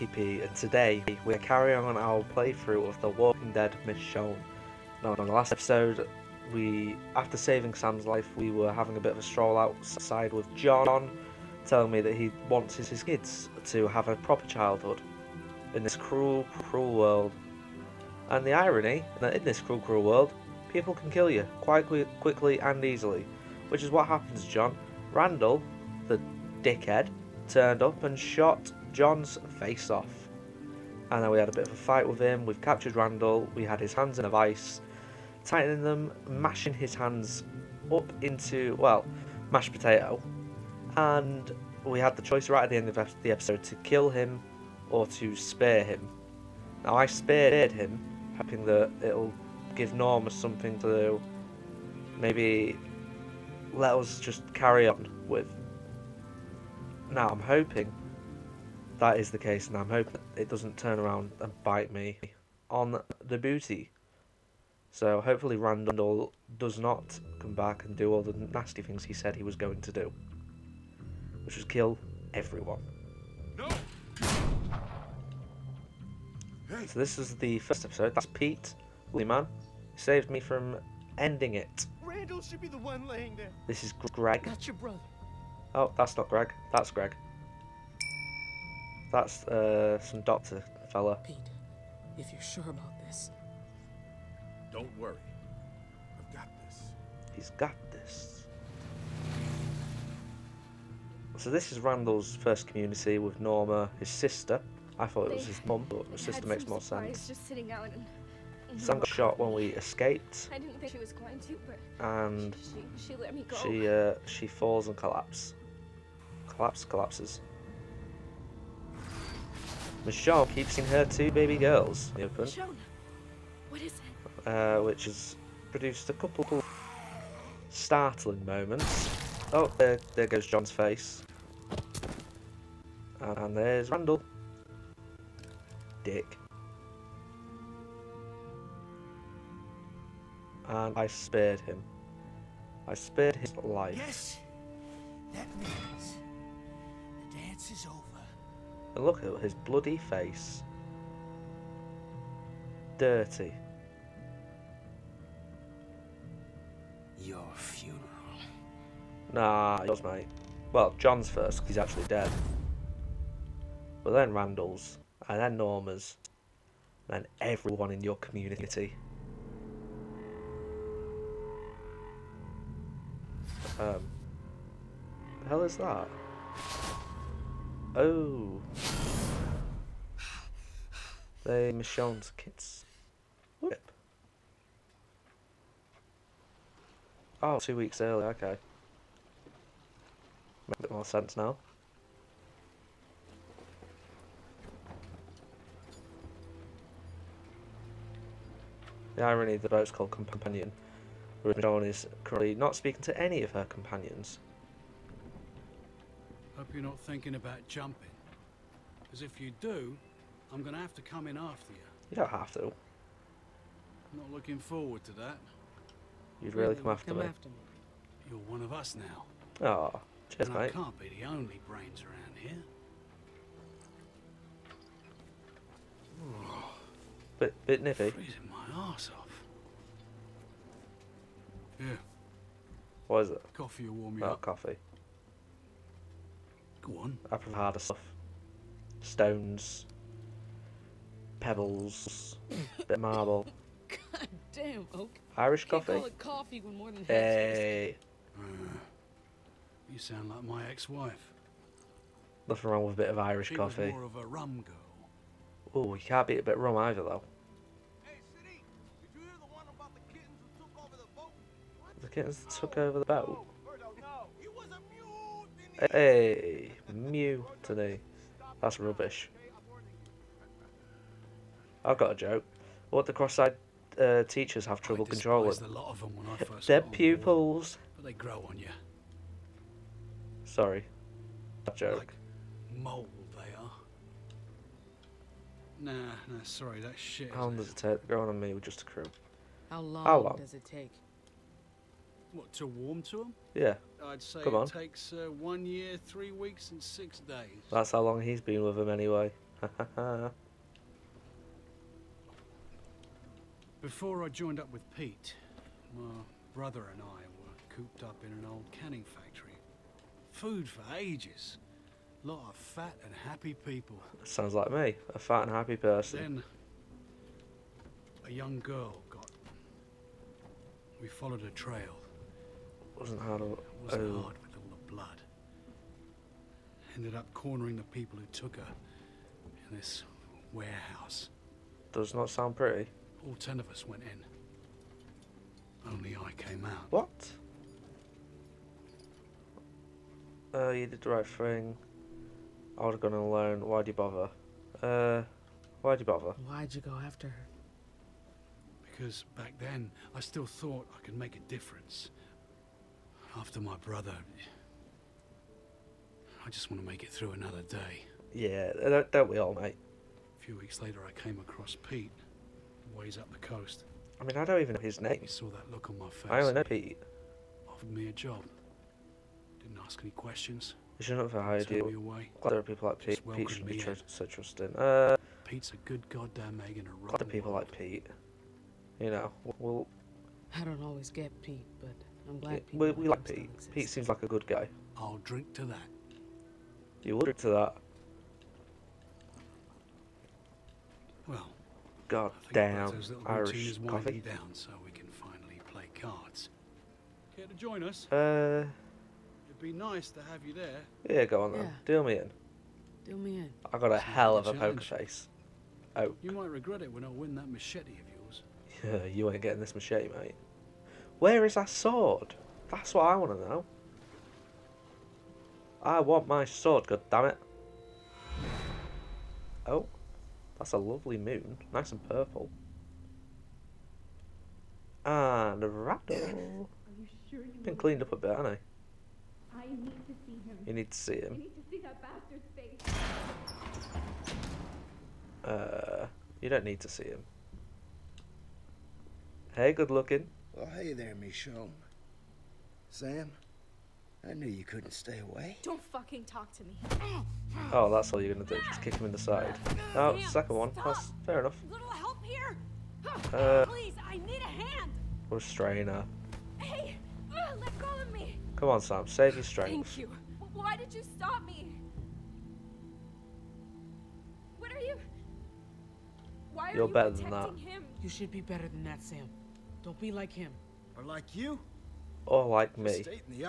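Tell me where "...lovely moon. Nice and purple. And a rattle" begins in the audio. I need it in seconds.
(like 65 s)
420 s.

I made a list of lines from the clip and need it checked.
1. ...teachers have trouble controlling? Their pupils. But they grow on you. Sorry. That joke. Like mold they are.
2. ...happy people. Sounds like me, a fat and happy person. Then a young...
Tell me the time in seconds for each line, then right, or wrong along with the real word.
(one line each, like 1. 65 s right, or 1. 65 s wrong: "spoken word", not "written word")
1. 274 s right
2. 313 s right.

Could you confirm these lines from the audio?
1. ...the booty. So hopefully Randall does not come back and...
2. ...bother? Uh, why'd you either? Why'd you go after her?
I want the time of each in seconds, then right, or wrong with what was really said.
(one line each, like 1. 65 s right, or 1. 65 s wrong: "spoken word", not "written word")
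1. 63 s right
2. 343 s wrong: "bother", not "either".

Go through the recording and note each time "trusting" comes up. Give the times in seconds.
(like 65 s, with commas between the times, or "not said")
374 s.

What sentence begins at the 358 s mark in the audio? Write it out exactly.
Yeah, don't, don't we all, mate?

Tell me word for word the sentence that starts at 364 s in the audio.
I mean, I don't even know his name.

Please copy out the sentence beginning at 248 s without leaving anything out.
Uh, you sound like my ex-wife.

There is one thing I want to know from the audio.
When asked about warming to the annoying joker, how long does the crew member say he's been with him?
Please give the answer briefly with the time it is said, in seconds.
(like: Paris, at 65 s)
1 year, 3 weeks, and 6 days, at 295 s.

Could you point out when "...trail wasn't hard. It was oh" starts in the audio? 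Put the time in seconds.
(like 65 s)
321 s.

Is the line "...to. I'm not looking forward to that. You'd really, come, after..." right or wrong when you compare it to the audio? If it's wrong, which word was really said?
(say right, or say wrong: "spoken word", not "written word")
right.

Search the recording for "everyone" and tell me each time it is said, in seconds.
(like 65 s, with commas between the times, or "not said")
72 s, 167 s.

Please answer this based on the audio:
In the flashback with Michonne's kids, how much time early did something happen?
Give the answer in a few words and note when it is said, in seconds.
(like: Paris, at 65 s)
Two weeks, at 187 s.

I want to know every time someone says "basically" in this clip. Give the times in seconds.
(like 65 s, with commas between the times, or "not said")
not said.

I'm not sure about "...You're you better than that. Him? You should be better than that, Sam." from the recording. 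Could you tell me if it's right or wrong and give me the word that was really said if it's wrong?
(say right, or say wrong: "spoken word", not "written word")
right.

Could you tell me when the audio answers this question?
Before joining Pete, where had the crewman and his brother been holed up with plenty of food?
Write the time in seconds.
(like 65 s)
308 s.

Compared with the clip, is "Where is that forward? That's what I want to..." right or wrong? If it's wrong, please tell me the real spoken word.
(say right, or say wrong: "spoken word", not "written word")
wrong: "sword", not "forward".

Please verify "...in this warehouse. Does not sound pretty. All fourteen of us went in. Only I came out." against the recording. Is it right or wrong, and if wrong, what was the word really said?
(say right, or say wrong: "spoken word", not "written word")
wrong: "ten", not "fourteen".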